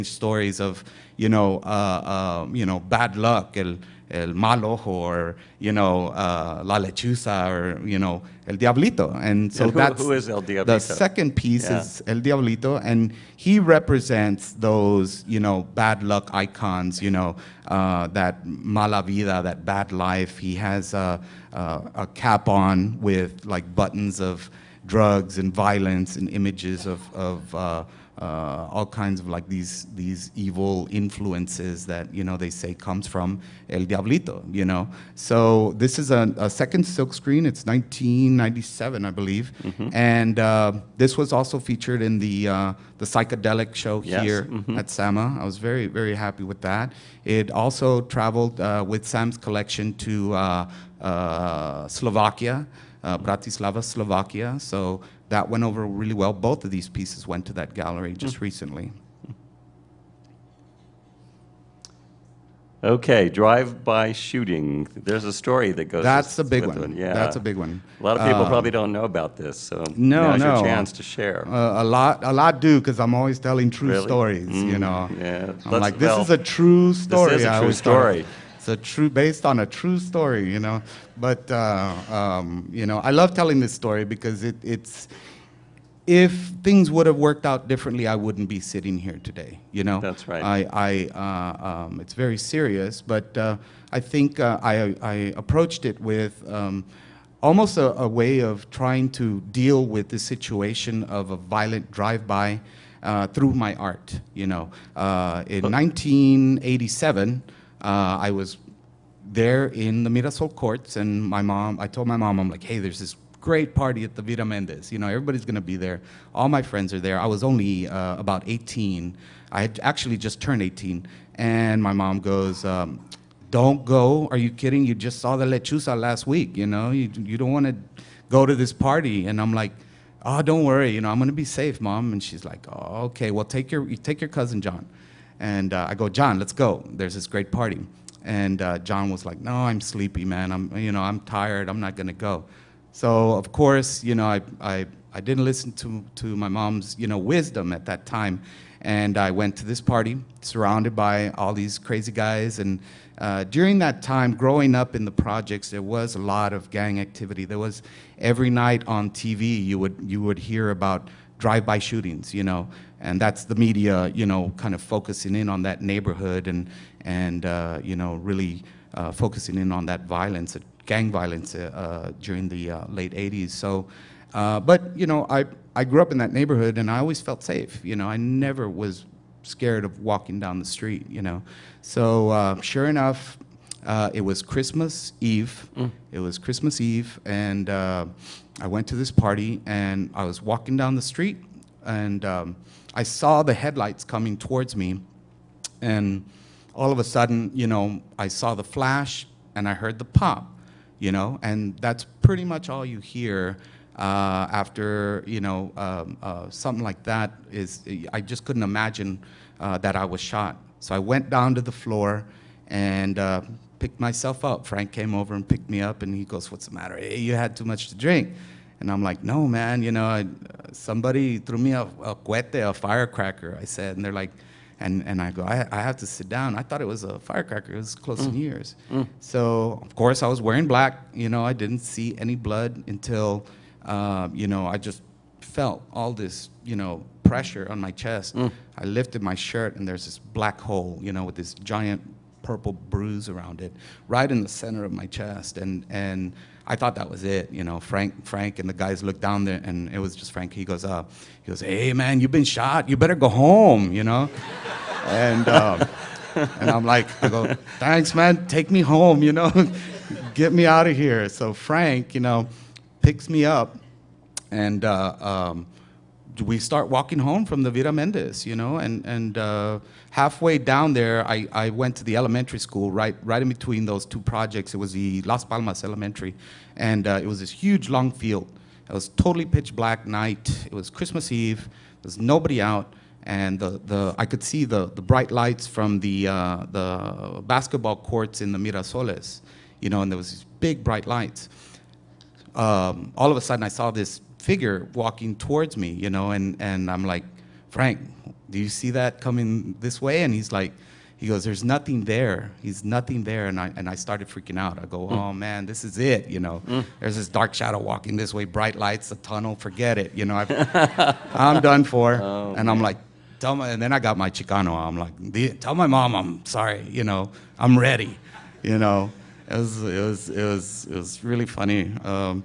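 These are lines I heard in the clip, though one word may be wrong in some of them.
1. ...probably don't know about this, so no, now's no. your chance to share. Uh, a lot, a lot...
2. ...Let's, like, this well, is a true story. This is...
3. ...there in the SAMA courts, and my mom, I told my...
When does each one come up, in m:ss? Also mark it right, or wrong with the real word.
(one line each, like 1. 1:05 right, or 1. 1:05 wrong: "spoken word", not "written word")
1. 1:08 right
2. 1:15 right
3. 1:49 wrong: "Mirasol", not "SAMA".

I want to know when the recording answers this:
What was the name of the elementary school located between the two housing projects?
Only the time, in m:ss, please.
4:35.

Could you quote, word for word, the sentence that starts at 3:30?
So I went down to the floor and uh, picked myself up.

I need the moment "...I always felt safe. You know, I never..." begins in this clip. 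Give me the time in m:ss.
2:56.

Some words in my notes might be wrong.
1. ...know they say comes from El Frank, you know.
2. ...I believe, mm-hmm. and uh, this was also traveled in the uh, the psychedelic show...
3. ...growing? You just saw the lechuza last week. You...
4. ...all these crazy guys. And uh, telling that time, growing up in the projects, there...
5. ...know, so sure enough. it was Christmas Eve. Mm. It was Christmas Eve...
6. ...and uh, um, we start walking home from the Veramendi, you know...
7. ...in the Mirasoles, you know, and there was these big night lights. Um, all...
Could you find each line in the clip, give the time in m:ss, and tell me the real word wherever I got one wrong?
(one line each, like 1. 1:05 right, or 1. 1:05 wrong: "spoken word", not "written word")
1. 0:32 wrong: "Diablito", not "Frank"
2. 0:39 wrong: "featured", not "traveled"
3. 2:04 wrong: "kidding", not "growing"
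4. 2:31 wrong: "during", not "telling"
5. 3:01 right
6. 4:24 right
7. 4:48 wrong: "bright", not "night".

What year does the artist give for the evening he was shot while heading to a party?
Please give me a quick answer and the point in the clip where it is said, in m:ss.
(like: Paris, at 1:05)
1987, at 1:45.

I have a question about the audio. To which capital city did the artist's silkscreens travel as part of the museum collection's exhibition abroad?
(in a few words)
Bratislava.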